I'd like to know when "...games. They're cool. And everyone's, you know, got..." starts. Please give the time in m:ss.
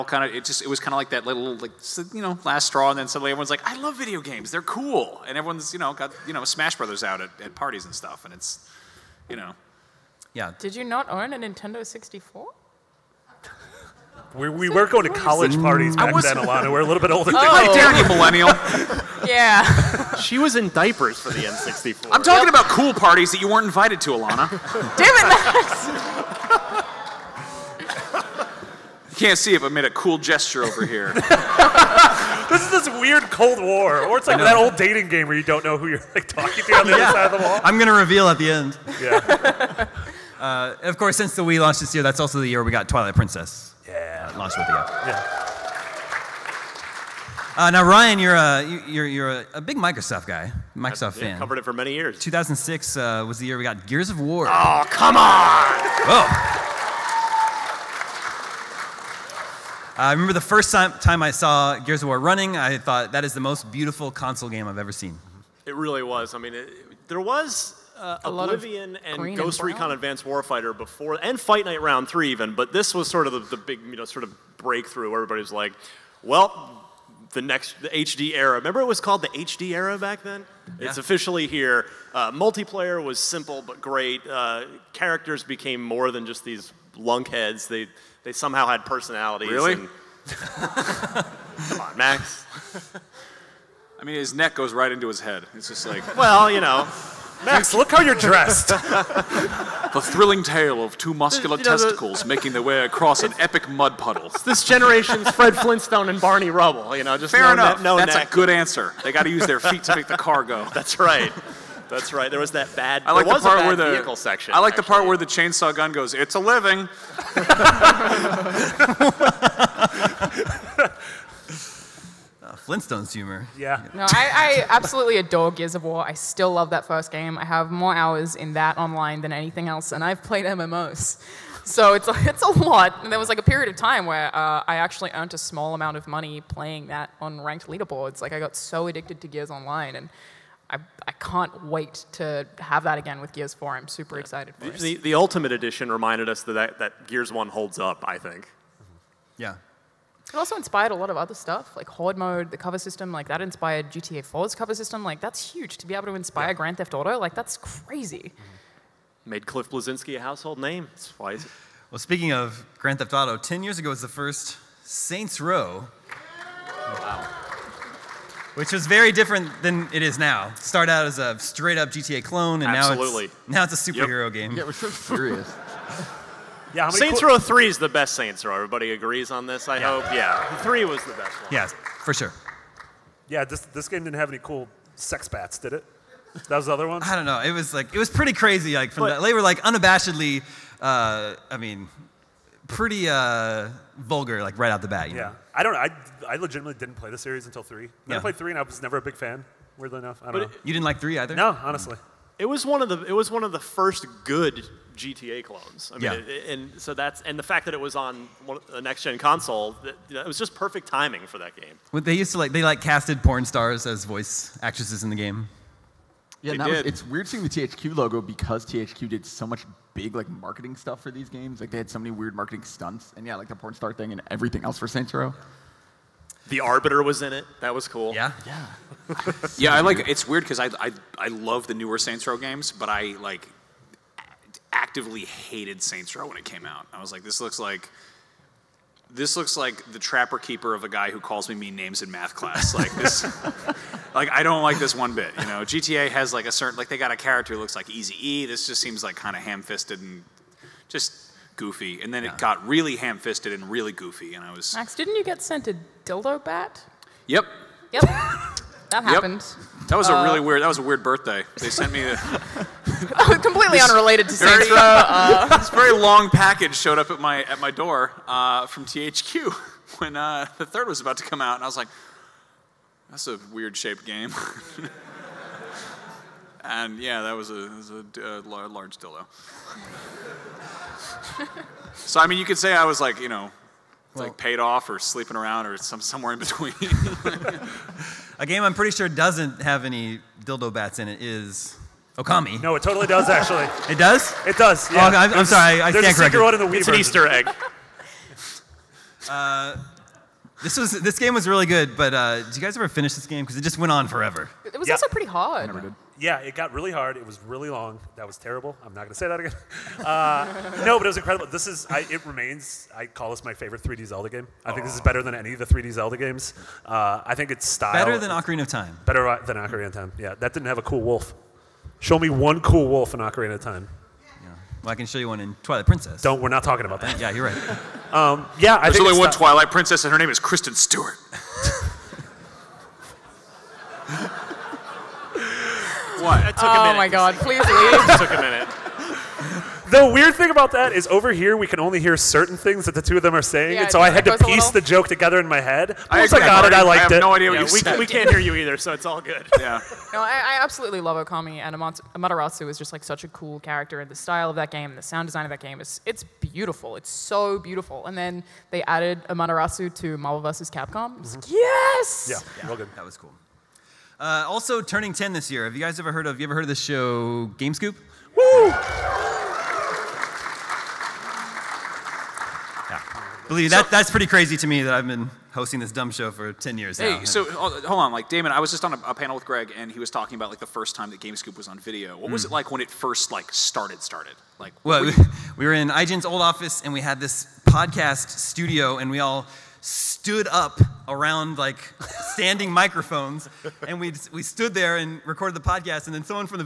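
0:04.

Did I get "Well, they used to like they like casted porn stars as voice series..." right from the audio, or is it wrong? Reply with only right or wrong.
wrong.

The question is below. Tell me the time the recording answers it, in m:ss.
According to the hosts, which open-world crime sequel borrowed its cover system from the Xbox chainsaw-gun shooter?
2:33.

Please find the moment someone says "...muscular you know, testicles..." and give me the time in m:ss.
1:41.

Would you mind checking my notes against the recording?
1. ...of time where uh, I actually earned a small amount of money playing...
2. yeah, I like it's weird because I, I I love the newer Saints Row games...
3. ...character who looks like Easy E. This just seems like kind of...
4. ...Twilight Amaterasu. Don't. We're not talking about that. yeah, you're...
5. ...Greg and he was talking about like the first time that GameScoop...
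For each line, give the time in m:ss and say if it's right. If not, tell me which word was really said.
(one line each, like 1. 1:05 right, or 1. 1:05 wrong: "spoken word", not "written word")
1. 2:13 right
2. 3:49 right
3. 4:07 right
4. 5:25 wrong: "Princess", not "Amaterasu"
5. 6:19 right.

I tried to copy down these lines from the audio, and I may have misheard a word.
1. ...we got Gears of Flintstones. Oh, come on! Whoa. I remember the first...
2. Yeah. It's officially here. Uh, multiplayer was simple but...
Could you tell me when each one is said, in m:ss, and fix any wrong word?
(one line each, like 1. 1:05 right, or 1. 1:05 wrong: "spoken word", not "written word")
1. 0:53 wrong: "War", not "Flintstones"
2. 1:20 right.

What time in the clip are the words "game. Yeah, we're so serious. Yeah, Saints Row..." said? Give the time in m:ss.
2:54.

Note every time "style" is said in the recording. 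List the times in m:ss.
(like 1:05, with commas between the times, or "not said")
5:17, 5:54.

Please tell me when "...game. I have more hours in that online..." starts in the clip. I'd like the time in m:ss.
2:07.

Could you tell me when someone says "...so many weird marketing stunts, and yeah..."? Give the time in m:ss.
3:41.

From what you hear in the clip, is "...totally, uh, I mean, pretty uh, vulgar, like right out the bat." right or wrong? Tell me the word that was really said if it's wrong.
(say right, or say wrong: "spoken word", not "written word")
wrong: "unabashedly", not "totally".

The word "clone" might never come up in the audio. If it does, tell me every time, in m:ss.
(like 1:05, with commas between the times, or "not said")
2:52, 3:25.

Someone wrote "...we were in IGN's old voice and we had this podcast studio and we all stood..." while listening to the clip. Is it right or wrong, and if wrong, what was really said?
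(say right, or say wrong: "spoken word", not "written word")
wrong: "office", not "voice".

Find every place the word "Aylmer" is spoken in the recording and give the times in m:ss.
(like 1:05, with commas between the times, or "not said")
not said.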